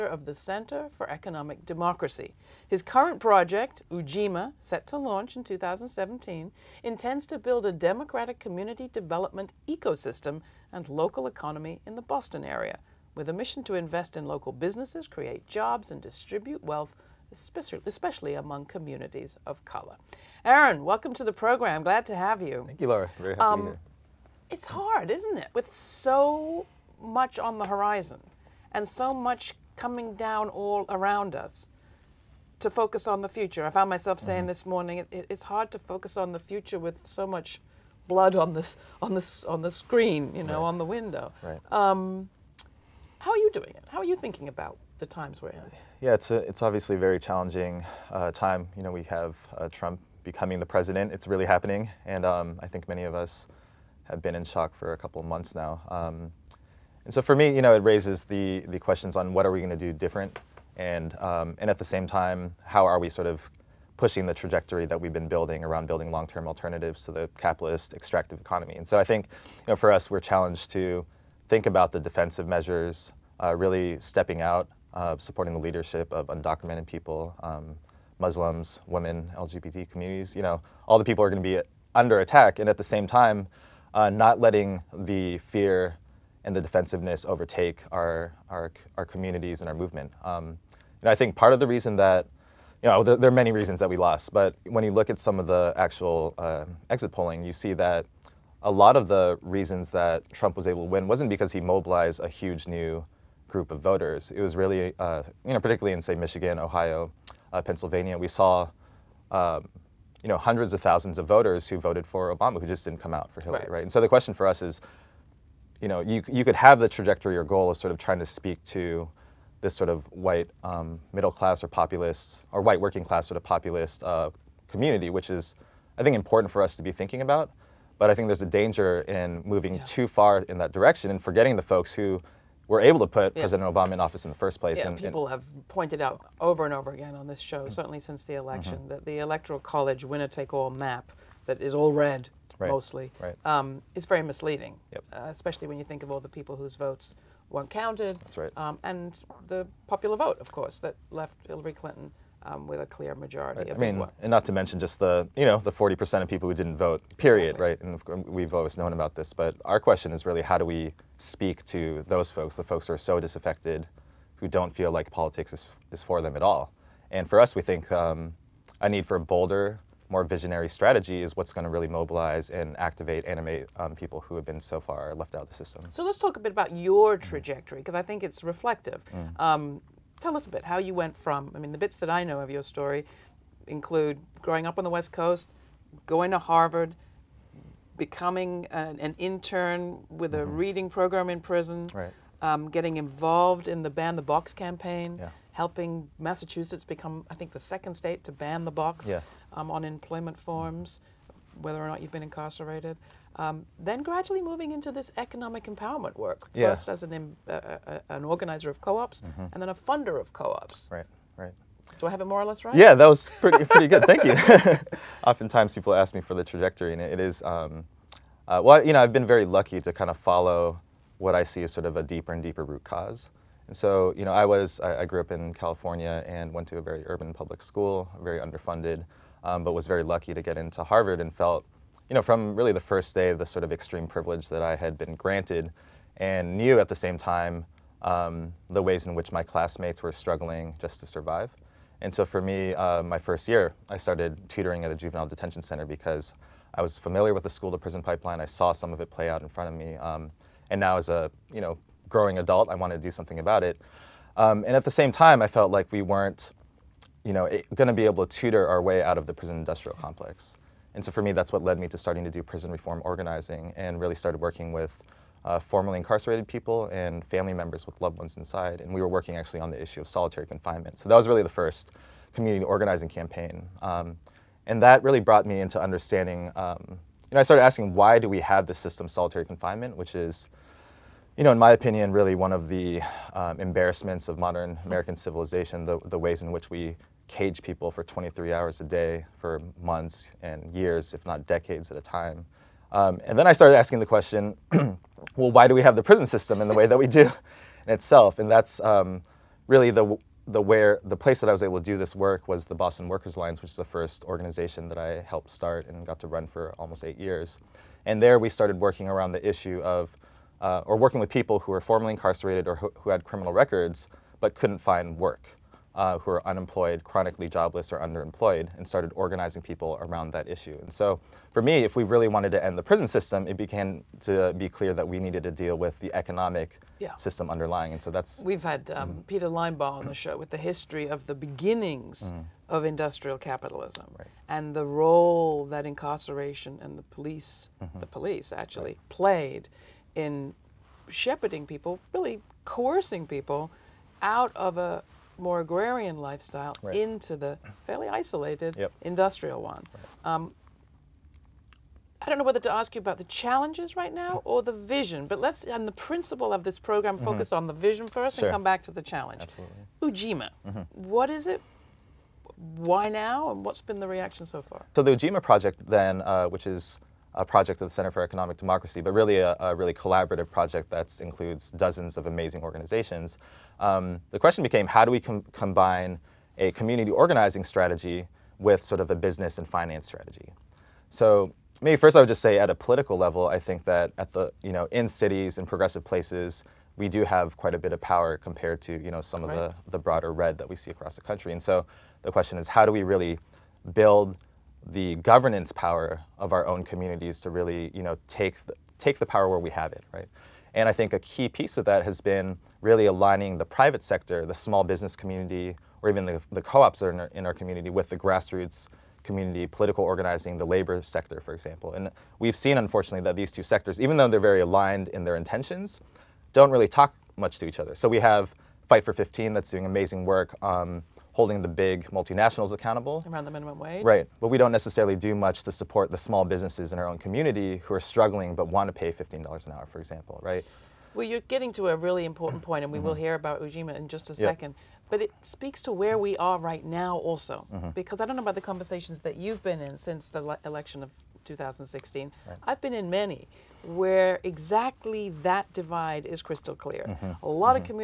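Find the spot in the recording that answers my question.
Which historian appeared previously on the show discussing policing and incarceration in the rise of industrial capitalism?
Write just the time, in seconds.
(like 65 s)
329 s.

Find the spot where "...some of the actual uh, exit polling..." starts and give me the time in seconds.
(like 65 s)
95 s.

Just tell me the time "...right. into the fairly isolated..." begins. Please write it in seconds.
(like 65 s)
346 s.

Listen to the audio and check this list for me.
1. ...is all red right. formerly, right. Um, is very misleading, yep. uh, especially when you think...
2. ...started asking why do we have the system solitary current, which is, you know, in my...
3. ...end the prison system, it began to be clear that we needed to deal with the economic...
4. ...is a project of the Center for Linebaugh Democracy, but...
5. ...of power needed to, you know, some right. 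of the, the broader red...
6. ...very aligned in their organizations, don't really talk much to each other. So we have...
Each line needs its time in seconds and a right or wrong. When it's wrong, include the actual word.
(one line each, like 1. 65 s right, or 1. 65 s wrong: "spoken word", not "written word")
1. 141 s wrong: "mostly", not "formerly"
2. 277 s wrong: "confinement", not "current"
3. 322 s right
4. 366 s wrong: "Economic", not "Linebaugh"
5. 387 s wrong: "compared", not "needed"
6. 414 s wrong: "intentions", not "organizations".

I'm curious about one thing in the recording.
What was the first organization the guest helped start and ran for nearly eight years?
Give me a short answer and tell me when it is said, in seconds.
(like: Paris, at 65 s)
Boston Workers Alliance, at 302 s.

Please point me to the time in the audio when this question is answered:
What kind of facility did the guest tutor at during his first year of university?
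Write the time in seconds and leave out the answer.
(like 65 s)
244 s.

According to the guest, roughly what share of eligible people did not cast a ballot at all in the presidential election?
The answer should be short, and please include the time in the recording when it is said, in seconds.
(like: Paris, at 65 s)
40 percent, at 155 s.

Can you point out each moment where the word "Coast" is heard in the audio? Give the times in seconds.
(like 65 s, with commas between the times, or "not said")
185 s.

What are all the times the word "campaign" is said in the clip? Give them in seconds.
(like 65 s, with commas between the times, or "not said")
194 s, 273 s.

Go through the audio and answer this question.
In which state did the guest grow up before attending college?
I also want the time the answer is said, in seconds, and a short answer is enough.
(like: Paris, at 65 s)
California, at 225 s.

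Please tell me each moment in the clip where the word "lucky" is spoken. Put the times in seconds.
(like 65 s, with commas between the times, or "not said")
219 s, 230 s.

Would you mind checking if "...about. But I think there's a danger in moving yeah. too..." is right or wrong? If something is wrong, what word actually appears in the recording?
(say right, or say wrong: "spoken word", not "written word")
right.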